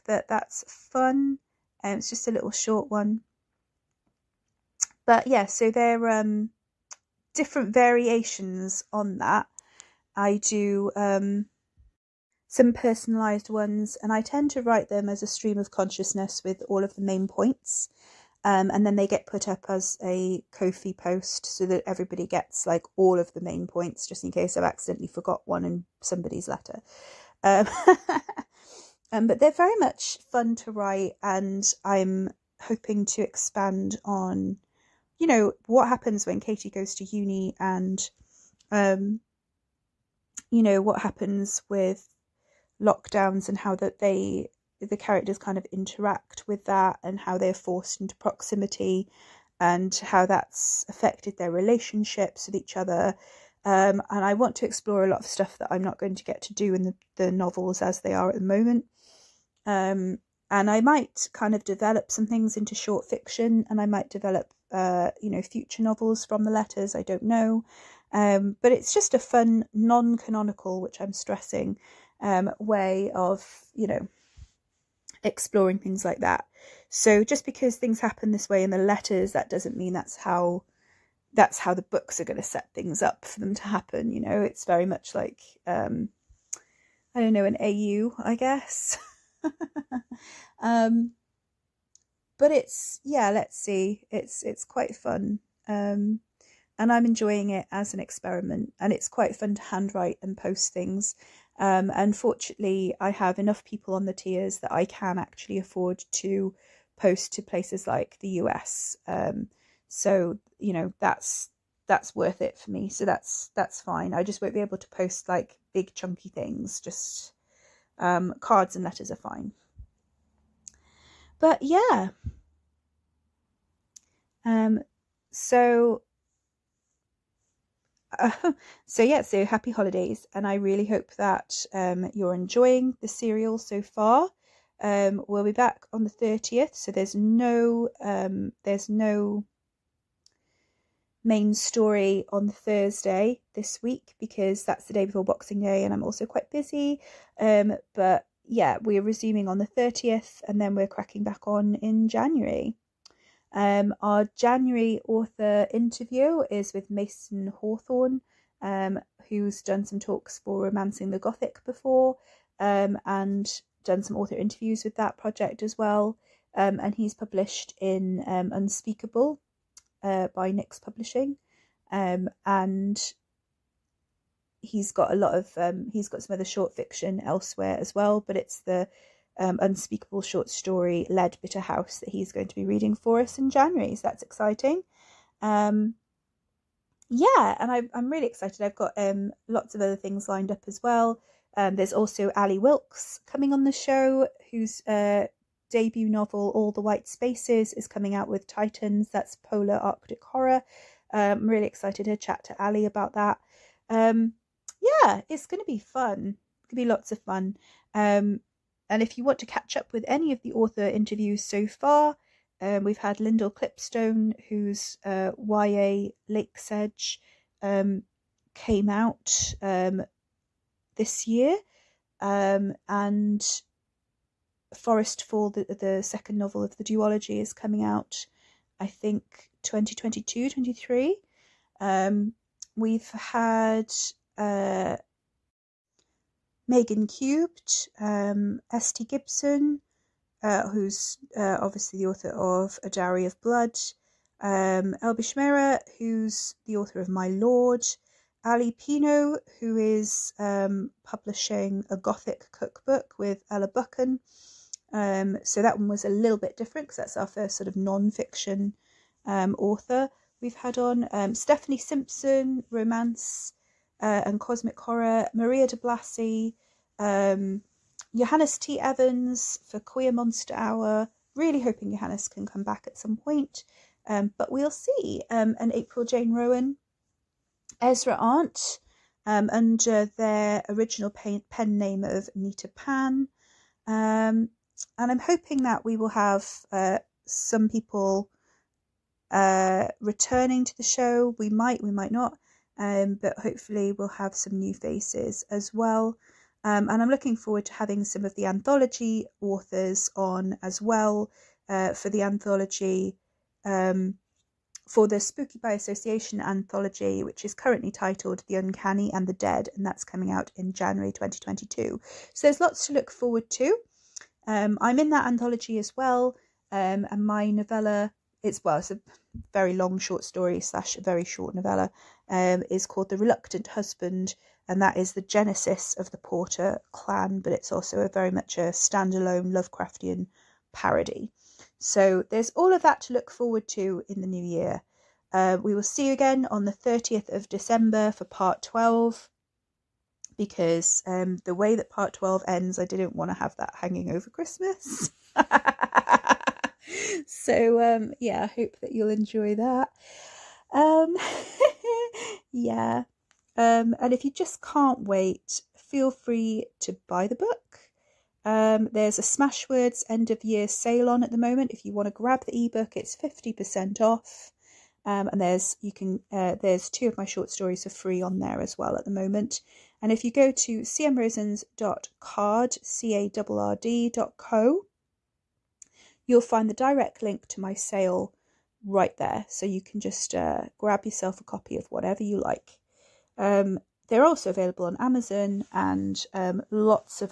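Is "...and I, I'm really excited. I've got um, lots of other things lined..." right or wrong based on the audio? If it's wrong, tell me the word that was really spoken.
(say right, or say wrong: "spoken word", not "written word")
right.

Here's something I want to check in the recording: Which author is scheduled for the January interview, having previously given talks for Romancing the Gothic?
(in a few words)
Mason Hawthorne.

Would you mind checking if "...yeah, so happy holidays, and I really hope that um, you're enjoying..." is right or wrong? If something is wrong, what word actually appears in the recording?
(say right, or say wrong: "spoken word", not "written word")
right.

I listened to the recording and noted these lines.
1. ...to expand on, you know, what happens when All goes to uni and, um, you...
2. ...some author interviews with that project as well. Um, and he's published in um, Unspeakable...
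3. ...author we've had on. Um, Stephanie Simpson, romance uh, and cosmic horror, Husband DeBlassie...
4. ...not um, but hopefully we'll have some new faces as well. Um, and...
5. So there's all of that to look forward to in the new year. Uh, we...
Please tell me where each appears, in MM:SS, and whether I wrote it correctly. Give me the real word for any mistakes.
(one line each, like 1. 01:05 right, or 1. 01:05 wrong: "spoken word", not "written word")
1. 00:33 wrong: "Katie", not "All"
2. 02:44 right
3. 04:19 wrong: "Maria", not "Husband"
4. 04:52 right
5. 05:31 right.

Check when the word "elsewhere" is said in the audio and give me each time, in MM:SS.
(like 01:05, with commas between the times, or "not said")
02:57.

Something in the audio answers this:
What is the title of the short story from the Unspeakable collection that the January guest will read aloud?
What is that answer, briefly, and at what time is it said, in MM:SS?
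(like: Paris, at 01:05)
Lead Bitter House, at 03:01.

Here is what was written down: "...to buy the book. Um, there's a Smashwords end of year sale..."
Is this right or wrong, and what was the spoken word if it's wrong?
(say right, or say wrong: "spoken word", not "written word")
right.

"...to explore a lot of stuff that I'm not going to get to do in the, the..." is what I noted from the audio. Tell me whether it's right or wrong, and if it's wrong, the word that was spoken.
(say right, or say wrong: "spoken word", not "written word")
right.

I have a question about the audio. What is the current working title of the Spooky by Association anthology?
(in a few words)
The Uncanny and the Dead.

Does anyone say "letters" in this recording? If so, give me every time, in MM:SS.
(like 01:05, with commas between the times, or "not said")
00:26, 01:06, 01:18, 01:58.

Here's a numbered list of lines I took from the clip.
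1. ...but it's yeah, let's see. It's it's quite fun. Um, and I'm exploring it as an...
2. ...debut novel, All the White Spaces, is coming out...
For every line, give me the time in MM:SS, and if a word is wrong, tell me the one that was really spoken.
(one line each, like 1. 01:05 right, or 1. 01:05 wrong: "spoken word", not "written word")
1. 01:32 wrong: "enjoying", not "exploring"
2. 03:15 right.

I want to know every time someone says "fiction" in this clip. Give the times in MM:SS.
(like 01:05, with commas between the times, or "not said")
01:03, 02:56, 04:18.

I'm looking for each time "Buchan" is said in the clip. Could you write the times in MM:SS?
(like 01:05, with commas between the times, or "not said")
04:13.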